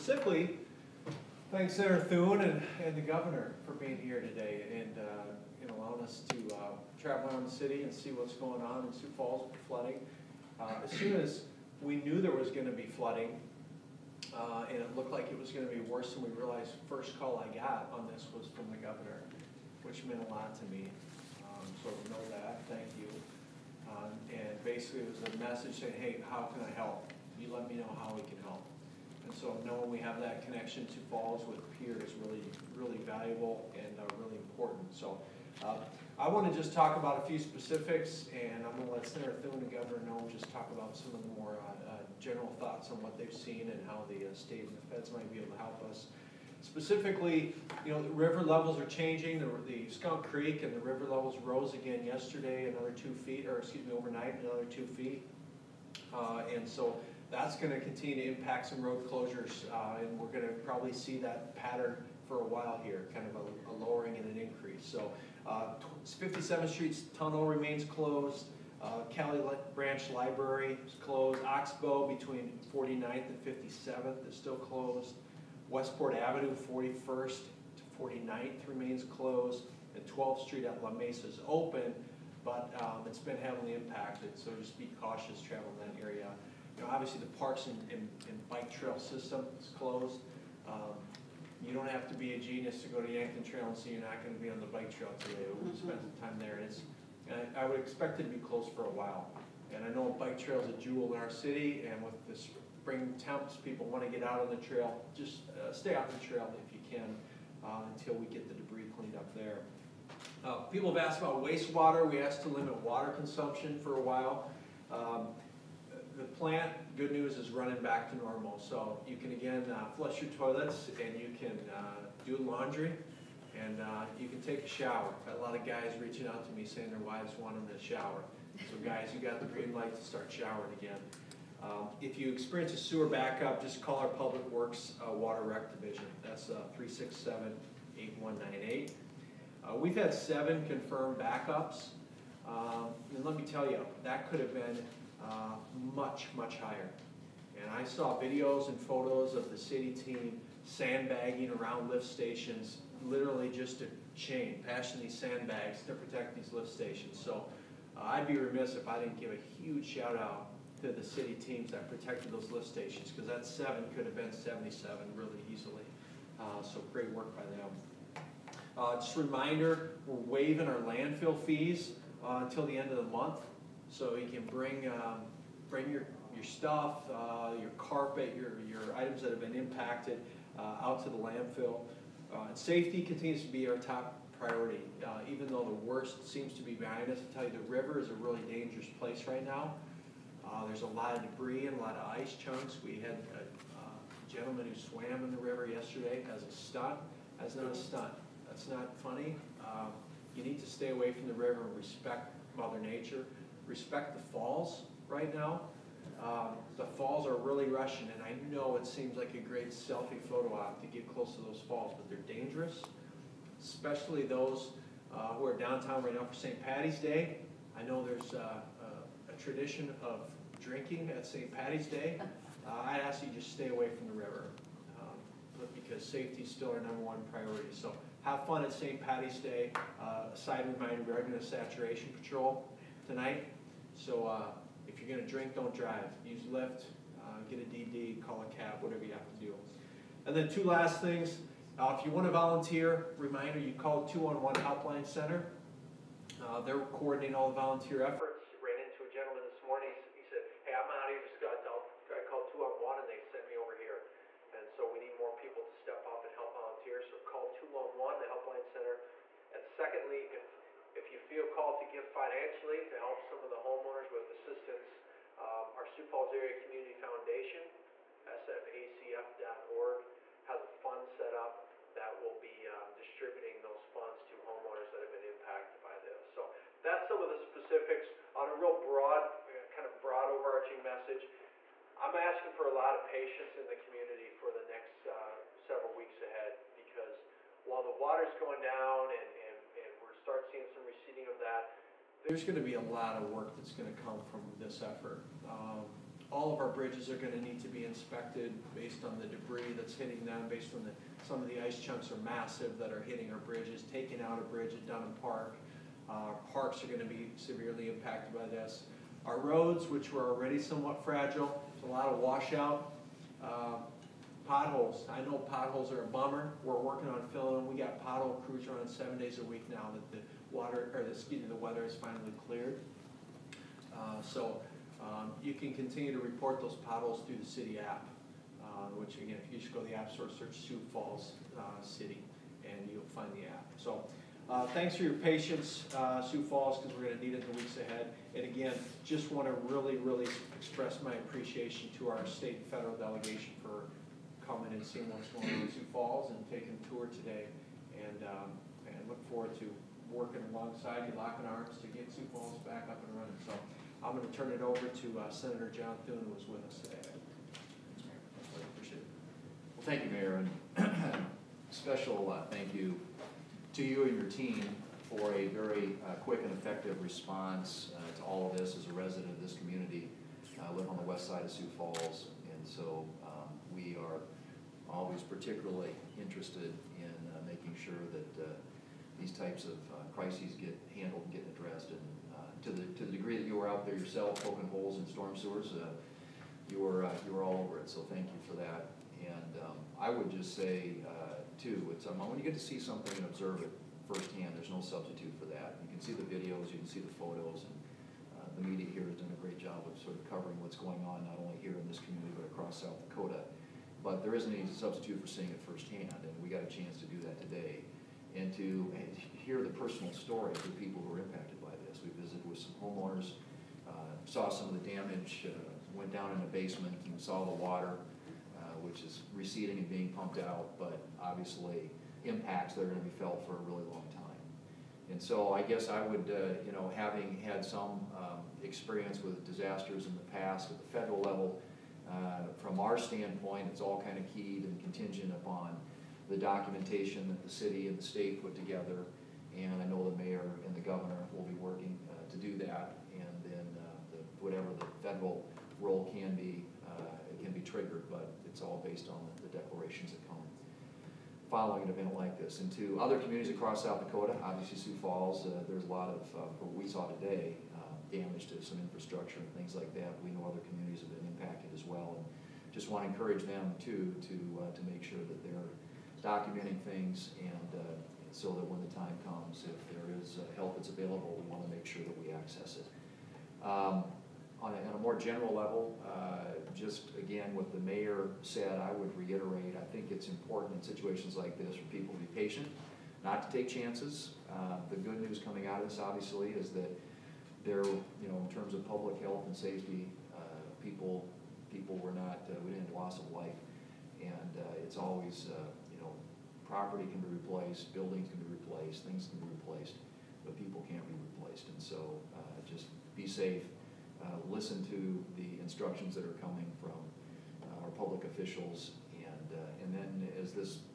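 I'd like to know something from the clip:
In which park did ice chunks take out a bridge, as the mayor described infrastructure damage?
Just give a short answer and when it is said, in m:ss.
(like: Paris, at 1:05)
Dunham Park, at 5:04.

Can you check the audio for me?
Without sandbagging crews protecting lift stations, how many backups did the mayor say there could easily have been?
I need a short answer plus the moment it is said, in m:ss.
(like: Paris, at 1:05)
77, at 2:44.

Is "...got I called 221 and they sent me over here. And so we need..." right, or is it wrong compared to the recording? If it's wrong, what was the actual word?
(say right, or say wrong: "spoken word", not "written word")
wrong: "211", not "221".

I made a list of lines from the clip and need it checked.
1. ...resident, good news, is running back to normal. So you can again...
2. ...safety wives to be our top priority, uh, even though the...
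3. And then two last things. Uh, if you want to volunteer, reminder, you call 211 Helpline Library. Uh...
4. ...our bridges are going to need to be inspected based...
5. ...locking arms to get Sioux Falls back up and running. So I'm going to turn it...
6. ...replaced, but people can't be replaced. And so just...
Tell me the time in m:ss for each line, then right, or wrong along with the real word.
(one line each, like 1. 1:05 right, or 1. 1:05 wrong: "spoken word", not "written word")
1. 1:56 wrong: "plant", not "resident"
2. 3:02 wrong: "continues", not "wives"
3. 4:00 wrong: "Center", not "Library"
4. 4:56 right
5. 5:51 right
6. 8:19 right.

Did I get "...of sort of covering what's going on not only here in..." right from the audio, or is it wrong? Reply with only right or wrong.
right.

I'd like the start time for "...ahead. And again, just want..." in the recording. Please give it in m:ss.
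5:37.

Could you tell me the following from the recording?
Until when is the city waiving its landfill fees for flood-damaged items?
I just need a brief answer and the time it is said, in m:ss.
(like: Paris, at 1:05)
end of the month, at 2:52.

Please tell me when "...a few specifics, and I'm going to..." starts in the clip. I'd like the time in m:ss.
0:37.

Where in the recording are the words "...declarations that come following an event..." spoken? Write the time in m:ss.
7:29.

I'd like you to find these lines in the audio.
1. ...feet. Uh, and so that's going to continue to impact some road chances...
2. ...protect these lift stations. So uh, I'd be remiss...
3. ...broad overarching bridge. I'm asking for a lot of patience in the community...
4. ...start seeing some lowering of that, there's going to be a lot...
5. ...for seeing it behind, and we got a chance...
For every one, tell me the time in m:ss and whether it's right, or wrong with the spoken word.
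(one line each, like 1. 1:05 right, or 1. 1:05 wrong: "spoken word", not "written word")
1. 0:54 wrong: "closures", not "chances"
2. 2:35 right
3. 4:40 wrong: "message", not "bridge"
4. 4:50 wrong: "receding", not "lowering"
5. 6:45 wrong: "firsthand", not "behind".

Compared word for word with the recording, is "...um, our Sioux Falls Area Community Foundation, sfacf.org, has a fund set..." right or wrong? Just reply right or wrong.
right.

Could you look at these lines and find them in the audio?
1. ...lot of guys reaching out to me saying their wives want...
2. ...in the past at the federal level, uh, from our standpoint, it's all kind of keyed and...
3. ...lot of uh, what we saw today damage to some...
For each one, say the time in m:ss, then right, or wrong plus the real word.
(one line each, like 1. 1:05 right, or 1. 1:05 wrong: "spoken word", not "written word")
1. 2:05 right
2. 7:10 right
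3. 7:35 right.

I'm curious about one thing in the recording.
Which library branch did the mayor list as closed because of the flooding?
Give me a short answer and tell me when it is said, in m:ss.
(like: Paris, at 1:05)
Caille Branch, at 1:09.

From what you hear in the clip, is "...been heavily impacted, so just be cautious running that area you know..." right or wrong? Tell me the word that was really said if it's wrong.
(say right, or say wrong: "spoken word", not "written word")
wrong: "traveling", not "running".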